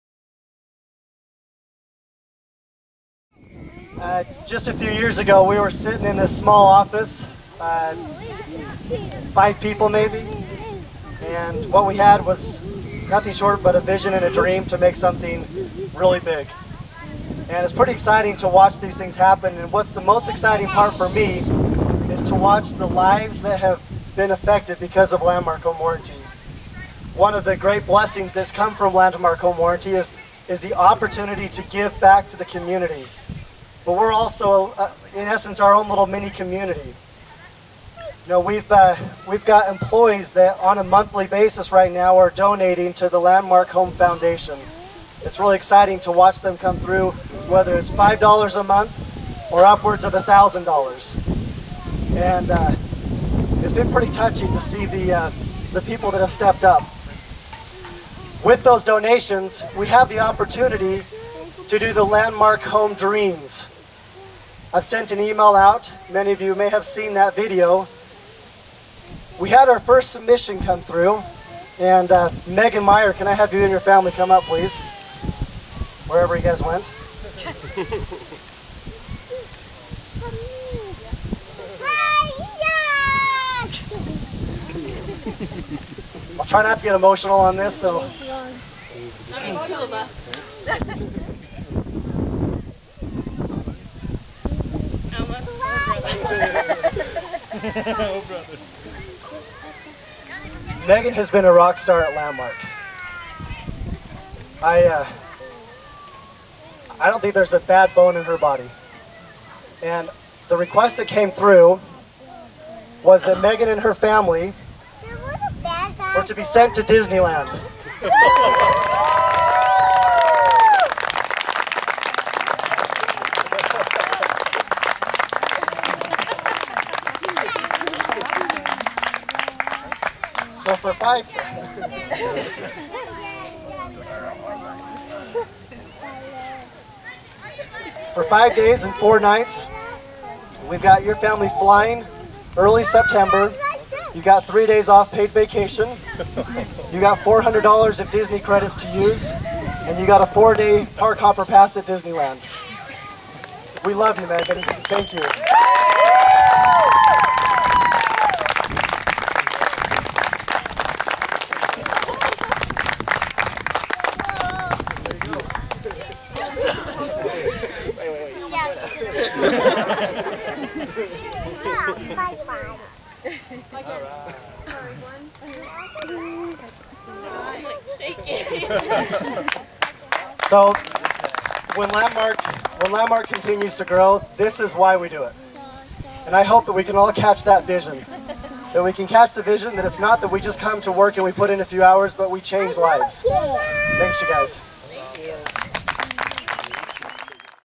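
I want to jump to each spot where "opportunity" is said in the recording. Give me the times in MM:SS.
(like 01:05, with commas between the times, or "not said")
00:30, 01:00.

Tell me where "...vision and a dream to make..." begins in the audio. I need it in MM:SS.
00:13.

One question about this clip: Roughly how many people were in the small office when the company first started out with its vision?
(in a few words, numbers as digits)
5.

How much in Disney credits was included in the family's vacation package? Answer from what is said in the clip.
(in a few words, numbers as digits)
$400.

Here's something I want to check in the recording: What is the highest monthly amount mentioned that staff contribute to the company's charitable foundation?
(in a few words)
$1,000.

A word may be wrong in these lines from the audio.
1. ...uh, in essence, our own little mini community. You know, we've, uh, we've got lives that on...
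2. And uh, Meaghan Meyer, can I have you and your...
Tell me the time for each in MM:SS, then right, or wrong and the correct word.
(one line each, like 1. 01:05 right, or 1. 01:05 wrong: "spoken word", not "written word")
1. 00:34 wrong: "employees", not "lives"
2. 01:11 right.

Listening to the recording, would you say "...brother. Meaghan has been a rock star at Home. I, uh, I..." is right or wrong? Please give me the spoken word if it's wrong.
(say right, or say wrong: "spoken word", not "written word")
wrong: "Landmark", not "Home".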